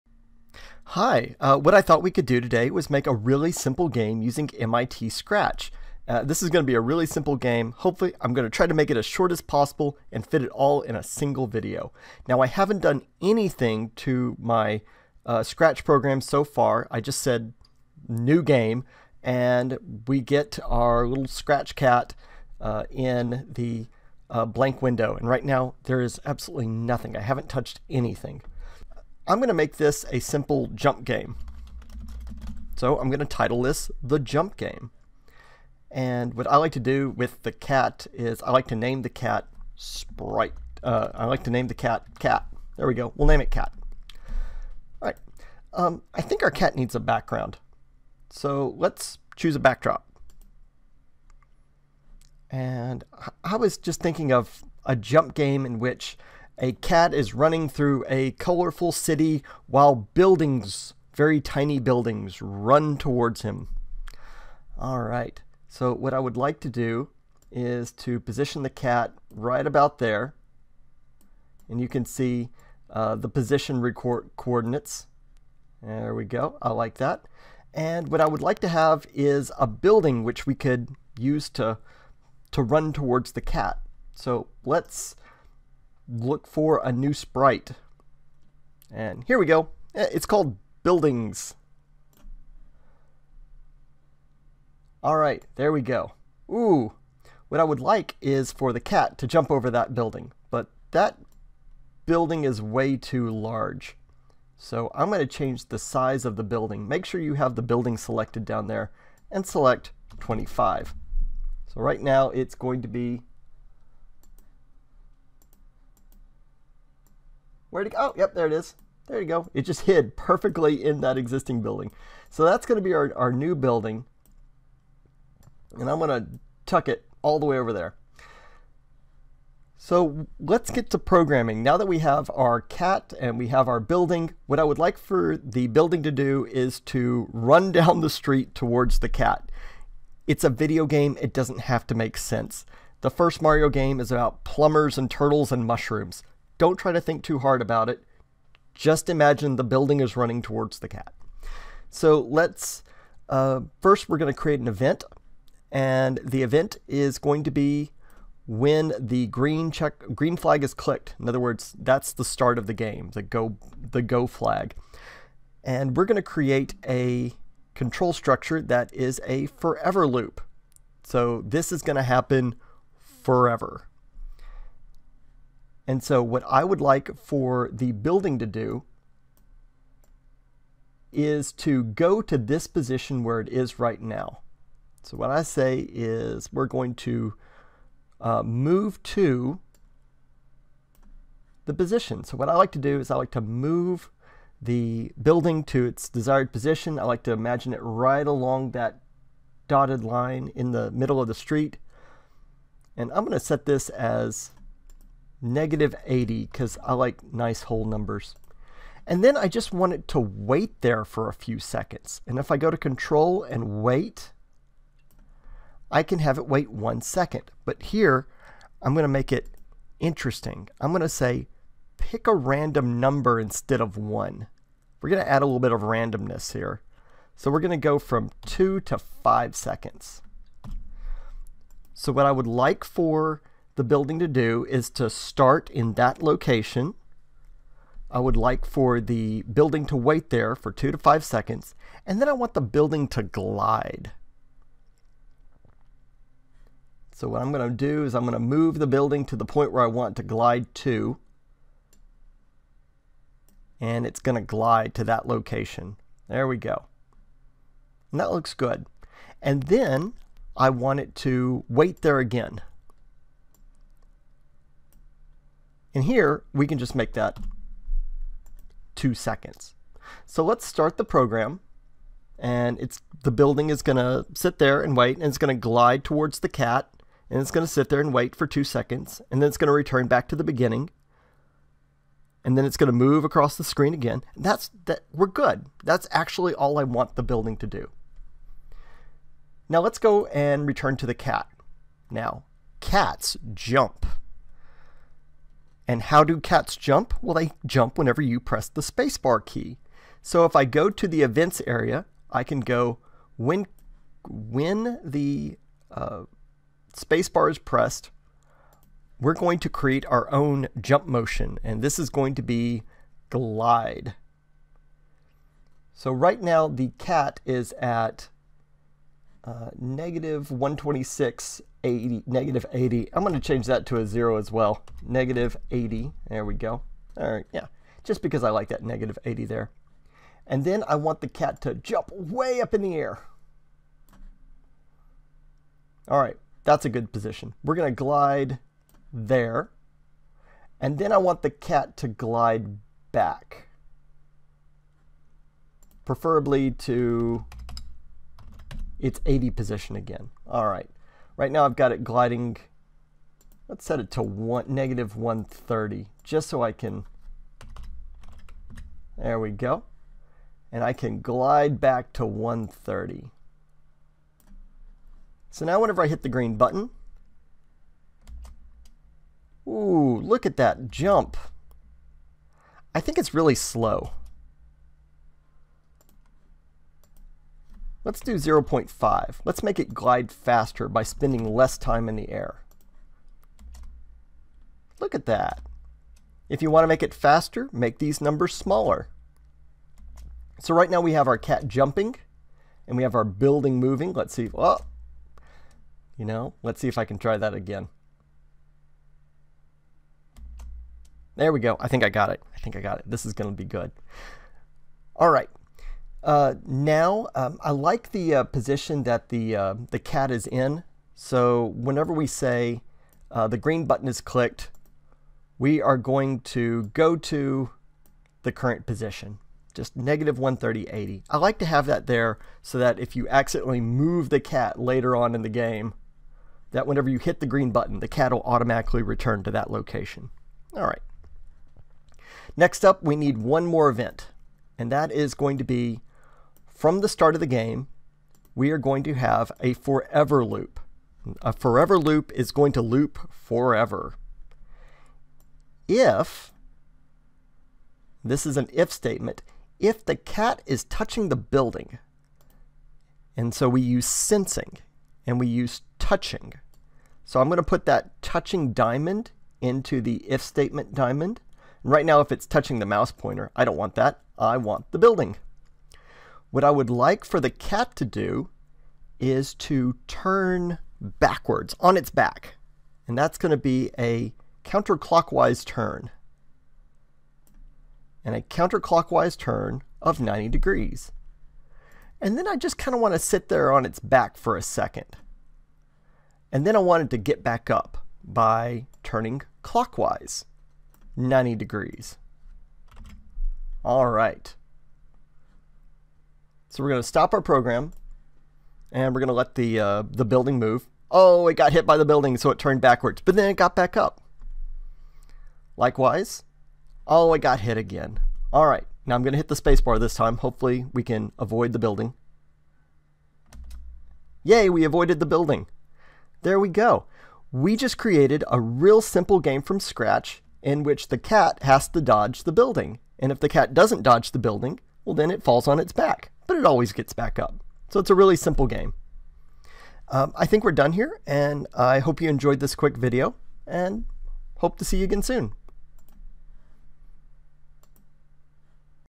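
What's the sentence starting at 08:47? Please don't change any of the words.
So it's a really simple game.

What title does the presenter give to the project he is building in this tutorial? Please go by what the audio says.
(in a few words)
The Jump Game.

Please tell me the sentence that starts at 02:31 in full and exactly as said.
So let's, uh, first we're going to create an event.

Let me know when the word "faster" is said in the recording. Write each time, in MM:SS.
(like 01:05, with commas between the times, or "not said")
06:20, 06:27.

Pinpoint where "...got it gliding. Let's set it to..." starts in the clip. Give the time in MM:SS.
05:51.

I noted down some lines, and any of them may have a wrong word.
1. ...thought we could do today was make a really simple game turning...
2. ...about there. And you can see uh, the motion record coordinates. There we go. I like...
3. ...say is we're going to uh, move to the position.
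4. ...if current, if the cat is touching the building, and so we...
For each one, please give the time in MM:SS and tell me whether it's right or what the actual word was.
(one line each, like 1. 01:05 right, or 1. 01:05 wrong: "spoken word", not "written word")
1. 00:01 wrong: "using", not "turning"
2. 01:09 wrong: "position", not "motion"
3. 03:05 right
4. 07:28 wrong: "statement", not "current".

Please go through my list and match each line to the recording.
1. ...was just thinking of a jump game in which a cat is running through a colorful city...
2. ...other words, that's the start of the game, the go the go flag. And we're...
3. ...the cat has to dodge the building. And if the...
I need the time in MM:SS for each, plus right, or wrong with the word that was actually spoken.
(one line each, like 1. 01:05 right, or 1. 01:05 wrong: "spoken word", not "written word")
1. 00:53 right
2. 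02:41 right
3. 08:41 right.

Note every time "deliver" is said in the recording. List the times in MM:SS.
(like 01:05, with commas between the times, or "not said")
not said.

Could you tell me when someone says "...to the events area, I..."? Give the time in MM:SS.
05:00.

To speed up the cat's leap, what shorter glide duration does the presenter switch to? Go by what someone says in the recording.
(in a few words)
0.5.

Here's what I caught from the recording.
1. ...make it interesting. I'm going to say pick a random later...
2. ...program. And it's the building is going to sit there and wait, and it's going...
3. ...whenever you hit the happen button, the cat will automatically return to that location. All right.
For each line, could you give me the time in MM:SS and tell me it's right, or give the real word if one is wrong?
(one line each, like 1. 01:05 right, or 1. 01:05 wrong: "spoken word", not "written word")
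1. 03:39 wrong: "number", not "later"
2. 04:31 right
3. 07:06 wrong: "green", not "happen".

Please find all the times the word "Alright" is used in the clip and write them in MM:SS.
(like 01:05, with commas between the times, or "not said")
01:35.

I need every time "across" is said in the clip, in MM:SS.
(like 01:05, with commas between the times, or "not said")
04:43.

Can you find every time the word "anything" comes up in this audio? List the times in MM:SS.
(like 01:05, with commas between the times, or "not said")
00:13, 00:27.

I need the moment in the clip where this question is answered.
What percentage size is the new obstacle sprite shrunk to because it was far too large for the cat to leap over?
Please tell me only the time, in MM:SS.
01:50.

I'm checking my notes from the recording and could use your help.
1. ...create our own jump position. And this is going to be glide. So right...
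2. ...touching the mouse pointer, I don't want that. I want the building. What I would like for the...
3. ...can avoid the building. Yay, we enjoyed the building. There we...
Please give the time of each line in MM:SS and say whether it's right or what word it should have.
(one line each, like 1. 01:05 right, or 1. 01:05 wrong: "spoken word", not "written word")
1. 05:09 wrong: "motion", not "position"
2. 07:42 right
3. 08:31 wrong: "avoided", not "enjoyed".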